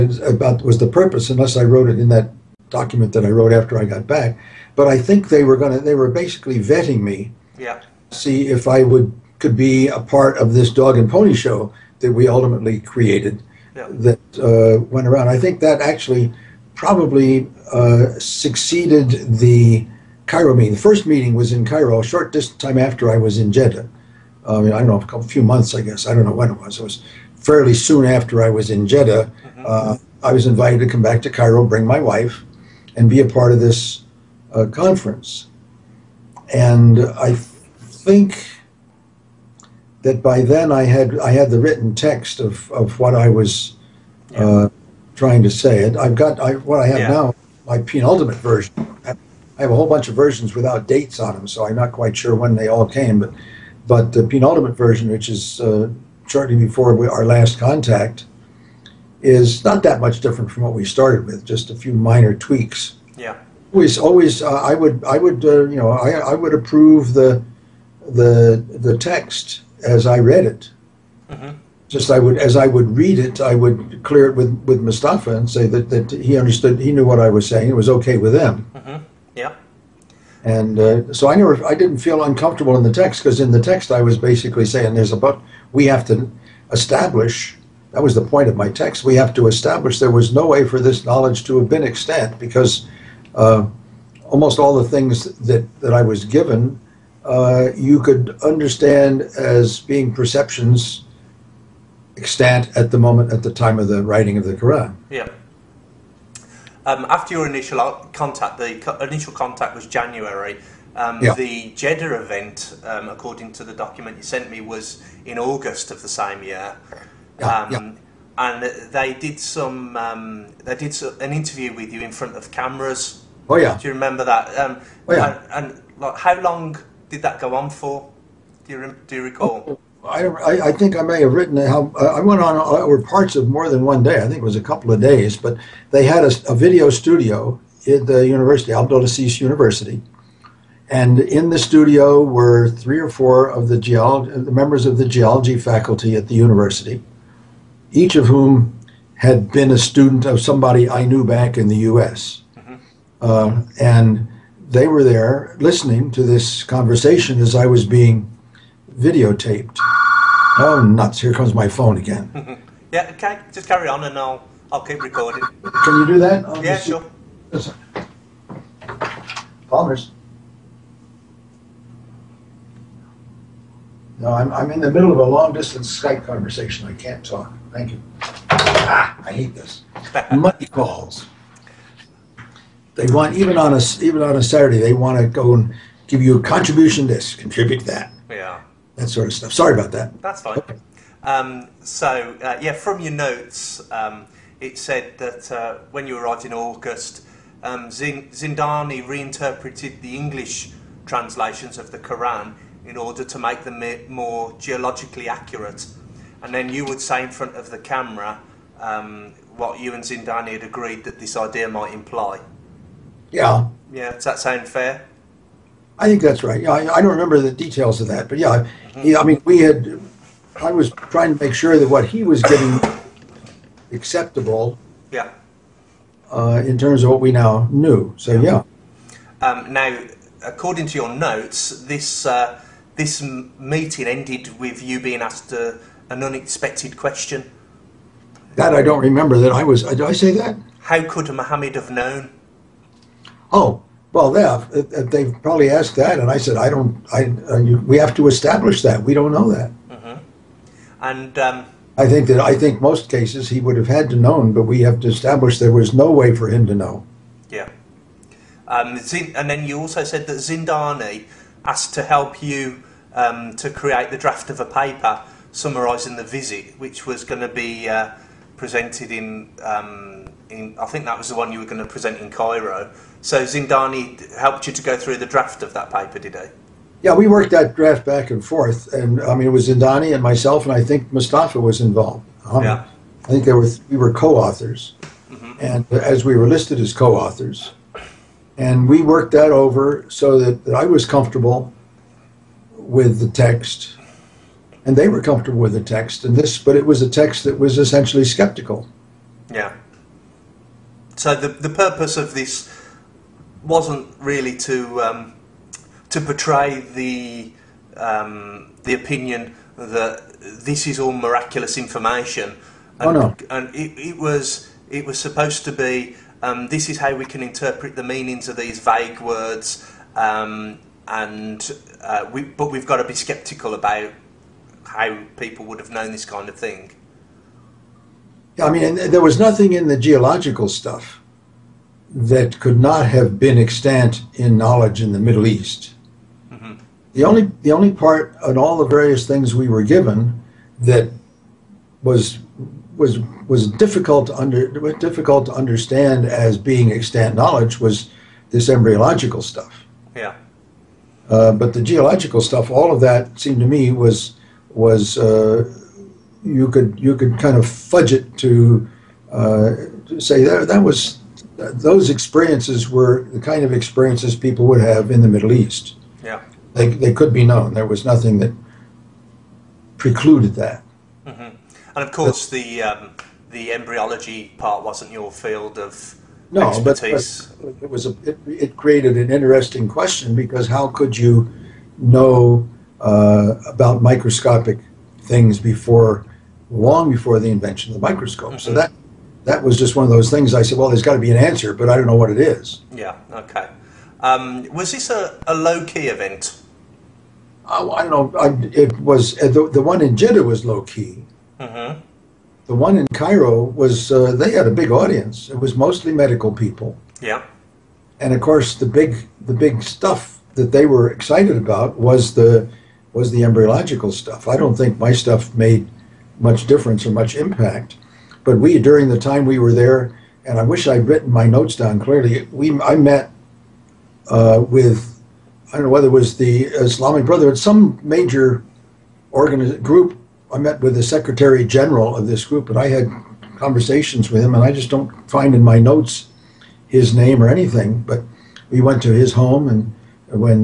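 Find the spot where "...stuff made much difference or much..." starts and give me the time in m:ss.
6:55.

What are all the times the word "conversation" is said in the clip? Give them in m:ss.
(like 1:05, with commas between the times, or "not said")
2:36, 2:56, 7:13.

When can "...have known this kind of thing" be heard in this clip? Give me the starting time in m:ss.
5:25.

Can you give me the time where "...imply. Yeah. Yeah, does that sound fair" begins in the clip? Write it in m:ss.
3:31.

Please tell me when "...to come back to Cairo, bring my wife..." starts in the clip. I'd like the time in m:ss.
0:30.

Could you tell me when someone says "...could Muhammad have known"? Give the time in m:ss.
4:01.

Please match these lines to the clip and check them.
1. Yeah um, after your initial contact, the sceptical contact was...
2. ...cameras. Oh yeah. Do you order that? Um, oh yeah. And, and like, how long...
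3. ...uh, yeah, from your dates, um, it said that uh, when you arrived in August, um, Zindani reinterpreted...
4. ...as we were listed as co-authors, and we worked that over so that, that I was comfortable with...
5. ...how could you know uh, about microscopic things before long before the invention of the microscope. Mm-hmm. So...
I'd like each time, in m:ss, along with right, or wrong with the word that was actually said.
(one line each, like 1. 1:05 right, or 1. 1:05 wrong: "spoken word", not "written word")
1. 1:45 wrong: "initial", not "sceptical"
2. 2:02 wrong: "remember", not "order"
3. 3:12 wrong: "notes", not "dates"
4. 4:45 right
5. 6:20 right.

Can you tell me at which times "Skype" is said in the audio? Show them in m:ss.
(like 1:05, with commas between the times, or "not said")
2:56.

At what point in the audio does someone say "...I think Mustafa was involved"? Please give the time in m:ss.
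4:40.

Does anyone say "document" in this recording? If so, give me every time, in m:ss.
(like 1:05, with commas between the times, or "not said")
0:02, 1:53.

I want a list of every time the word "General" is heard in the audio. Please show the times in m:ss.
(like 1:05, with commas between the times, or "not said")
7:11.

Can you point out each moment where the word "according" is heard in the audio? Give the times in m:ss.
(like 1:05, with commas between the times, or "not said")
1:53, 3:50.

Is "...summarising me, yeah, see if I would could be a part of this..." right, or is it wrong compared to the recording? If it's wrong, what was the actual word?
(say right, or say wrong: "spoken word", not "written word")
wrong: "vetting", not "summarising".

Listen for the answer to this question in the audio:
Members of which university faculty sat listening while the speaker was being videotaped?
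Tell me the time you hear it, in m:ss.
2:24.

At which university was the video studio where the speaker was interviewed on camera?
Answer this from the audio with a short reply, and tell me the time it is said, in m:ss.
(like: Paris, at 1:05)
Abdulaziz University, at 2:18.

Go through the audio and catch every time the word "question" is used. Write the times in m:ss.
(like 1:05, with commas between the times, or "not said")
3:56, 6:19.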